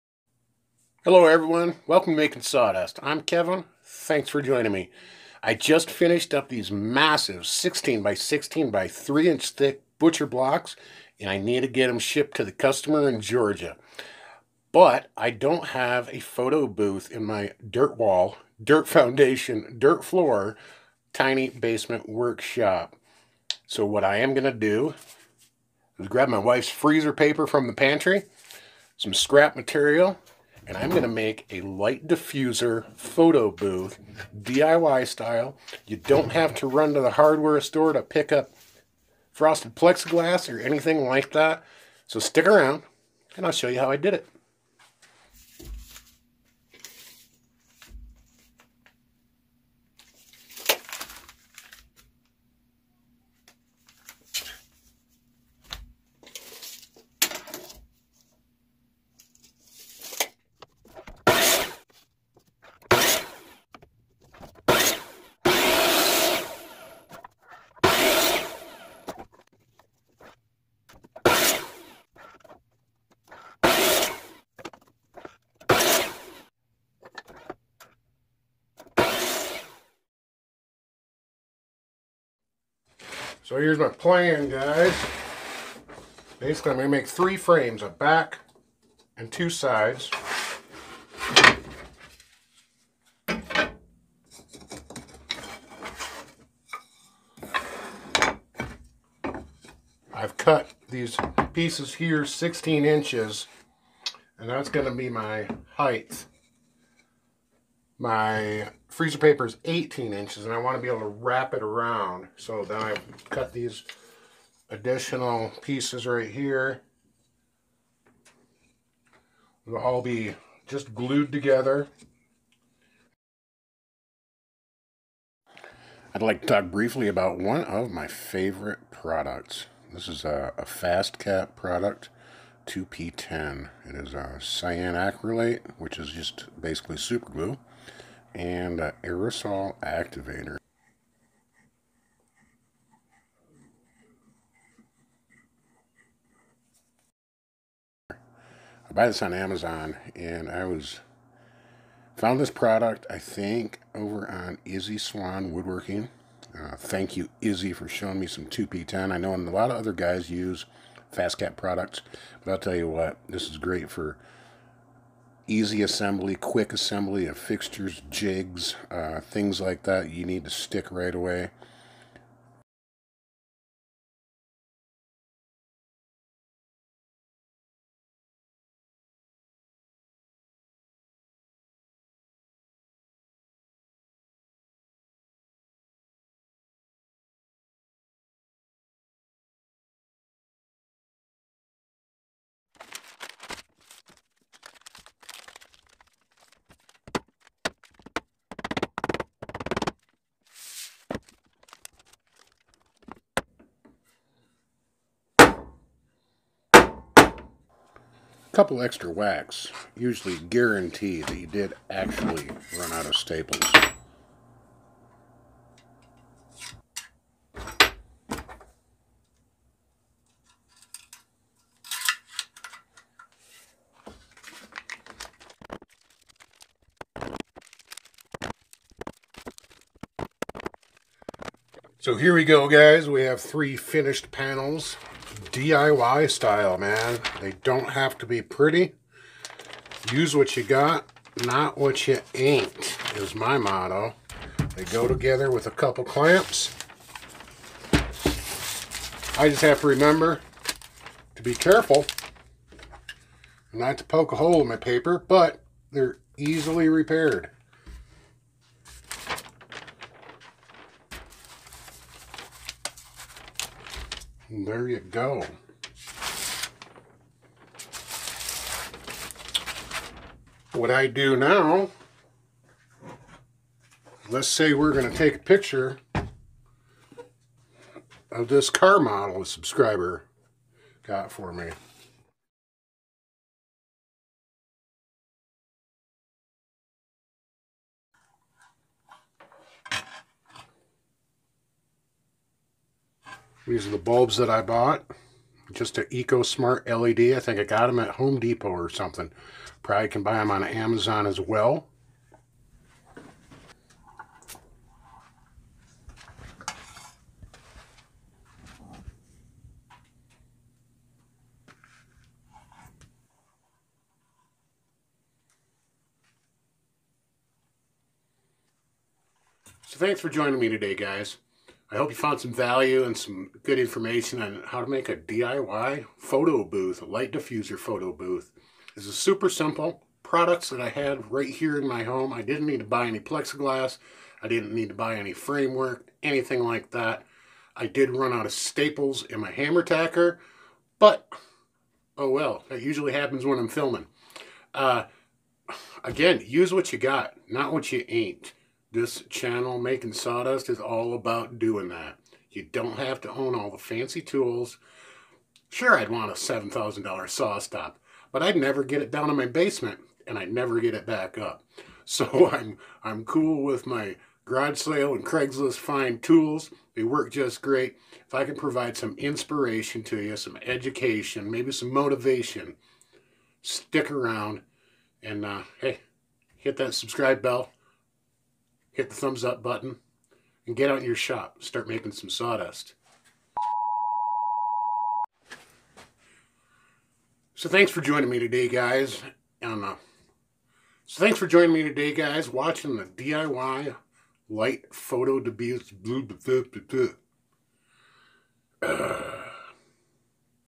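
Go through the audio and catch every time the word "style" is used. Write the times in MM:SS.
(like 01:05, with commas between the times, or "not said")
00:35, 03:56.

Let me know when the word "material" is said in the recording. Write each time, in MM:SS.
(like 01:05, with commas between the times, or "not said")
00:29.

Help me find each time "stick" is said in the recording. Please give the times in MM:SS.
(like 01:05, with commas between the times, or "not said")
00:42, 02:50, 06:13.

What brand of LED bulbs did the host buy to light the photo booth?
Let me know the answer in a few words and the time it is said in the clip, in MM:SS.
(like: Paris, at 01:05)
EcoSmart, at 04:56.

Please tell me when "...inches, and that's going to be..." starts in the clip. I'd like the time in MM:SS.
01:42.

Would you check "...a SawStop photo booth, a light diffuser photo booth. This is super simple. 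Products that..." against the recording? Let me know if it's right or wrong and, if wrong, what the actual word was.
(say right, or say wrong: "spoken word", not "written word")
wrong: "DIY", not "SawStop".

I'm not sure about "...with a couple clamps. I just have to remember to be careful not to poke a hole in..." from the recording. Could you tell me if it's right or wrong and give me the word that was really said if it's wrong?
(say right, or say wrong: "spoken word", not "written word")
right.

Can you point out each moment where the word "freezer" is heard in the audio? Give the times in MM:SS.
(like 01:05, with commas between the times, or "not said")
00:26, 01:48.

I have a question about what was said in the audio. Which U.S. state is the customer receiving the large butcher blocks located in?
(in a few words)
Georgia.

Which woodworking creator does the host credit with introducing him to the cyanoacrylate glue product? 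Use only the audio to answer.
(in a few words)
Izzy Swan.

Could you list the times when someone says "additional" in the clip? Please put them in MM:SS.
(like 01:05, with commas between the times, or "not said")
01:54.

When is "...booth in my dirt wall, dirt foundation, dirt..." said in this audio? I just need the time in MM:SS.
00:16.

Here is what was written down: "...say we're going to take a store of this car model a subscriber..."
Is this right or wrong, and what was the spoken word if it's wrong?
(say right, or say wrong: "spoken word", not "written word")
wrong: "picture", not "store".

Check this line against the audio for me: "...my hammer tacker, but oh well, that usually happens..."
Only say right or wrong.
right.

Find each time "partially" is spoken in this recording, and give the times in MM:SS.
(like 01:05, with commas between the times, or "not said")
not said.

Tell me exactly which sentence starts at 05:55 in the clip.
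Sure, I'd want a $7,000 SawStop, but I'd never get it down in my basement, and I'd never get it back up.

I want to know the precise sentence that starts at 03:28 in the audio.
couple extra whacks usually guarantee that you did actually run out of staples.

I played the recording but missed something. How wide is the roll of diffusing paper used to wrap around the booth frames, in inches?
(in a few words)
18.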